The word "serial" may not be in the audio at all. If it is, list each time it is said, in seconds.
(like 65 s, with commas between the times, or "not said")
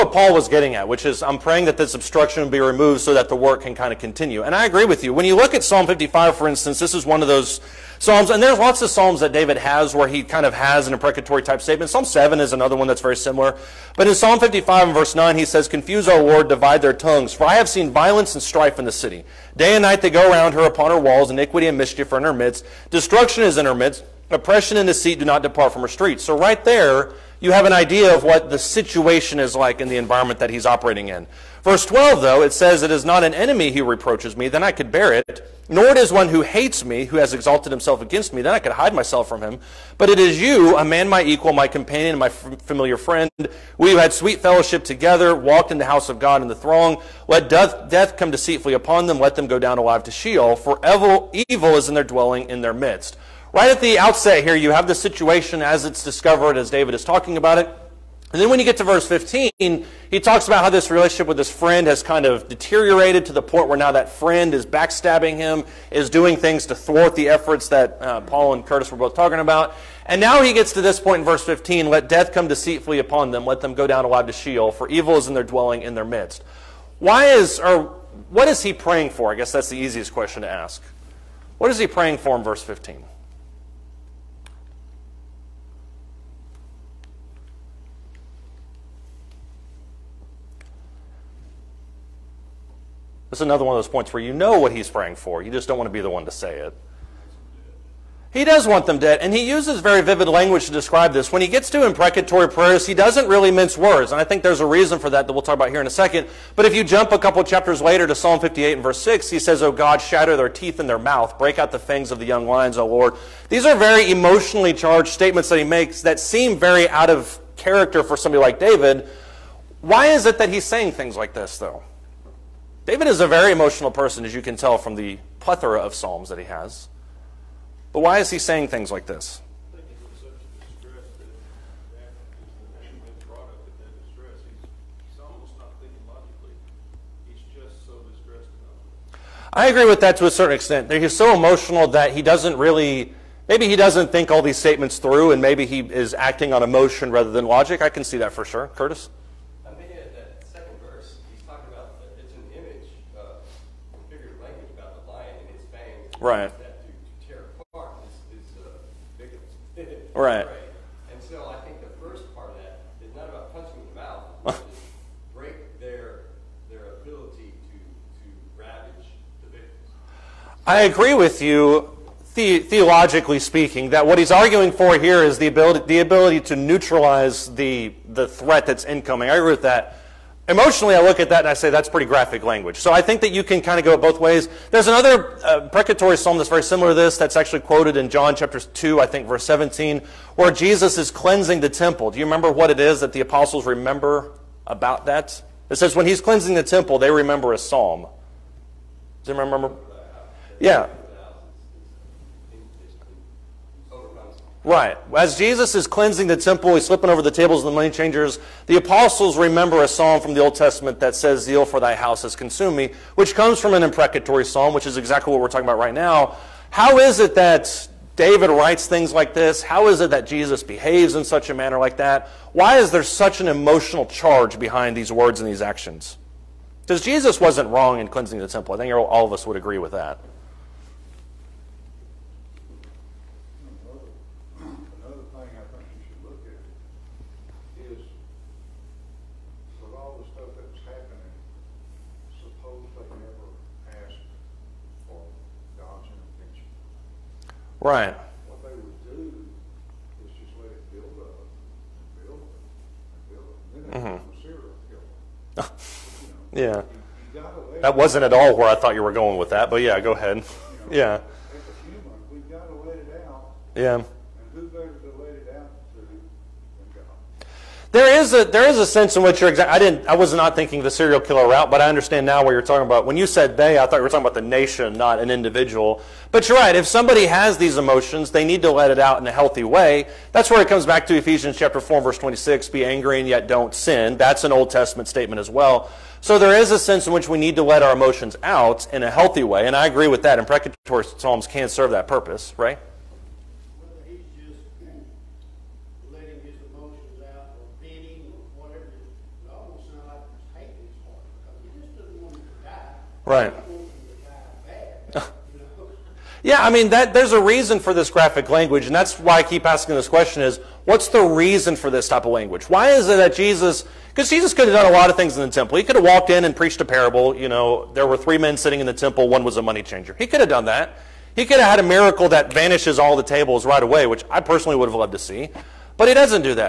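254 s, 270 s.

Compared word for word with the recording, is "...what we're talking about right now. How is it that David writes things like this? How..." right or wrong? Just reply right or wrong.
right.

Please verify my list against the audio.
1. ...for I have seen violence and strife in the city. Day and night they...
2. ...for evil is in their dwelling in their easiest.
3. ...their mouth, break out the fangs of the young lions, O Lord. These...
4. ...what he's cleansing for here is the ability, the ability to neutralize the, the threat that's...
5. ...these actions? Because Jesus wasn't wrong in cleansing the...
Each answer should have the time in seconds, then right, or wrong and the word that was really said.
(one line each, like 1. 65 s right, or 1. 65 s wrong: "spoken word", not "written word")
1. 17 s right
2. 74 s wrong: "midst", not "easiest"
3. 110 s right
4. 174 s wrong: "arguing", not "cleansing"
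5. 225 s right.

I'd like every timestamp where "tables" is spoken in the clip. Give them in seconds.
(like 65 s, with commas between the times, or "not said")
207 s, 323 s.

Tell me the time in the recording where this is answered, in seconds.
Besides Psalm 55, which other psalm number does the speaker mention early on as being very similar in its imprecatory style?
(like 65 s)
11 s.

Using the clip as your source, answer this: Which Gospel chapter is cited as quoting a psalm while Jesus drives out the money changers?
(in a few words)
John chapter 2.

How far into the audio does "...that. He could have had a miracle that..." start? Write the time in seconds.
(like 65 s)
320 s.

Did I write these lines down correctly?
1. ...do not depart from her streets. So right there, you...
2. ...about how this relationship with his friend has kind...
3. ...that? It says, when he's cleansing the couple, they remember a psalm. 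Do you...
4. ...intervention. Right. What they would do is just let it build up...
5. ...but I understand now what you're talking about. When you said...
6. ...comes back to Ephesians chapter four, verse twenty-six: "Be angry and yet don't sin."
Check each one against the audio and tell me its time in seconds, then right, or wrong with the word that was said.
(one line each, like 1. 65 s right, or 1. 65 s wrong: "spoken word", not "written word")
1. 25 s right
2. 60 s right
3. 195 s wrong: "temple", not "couple"
4. 246 s right
5. 271 s right
6. 280 s right.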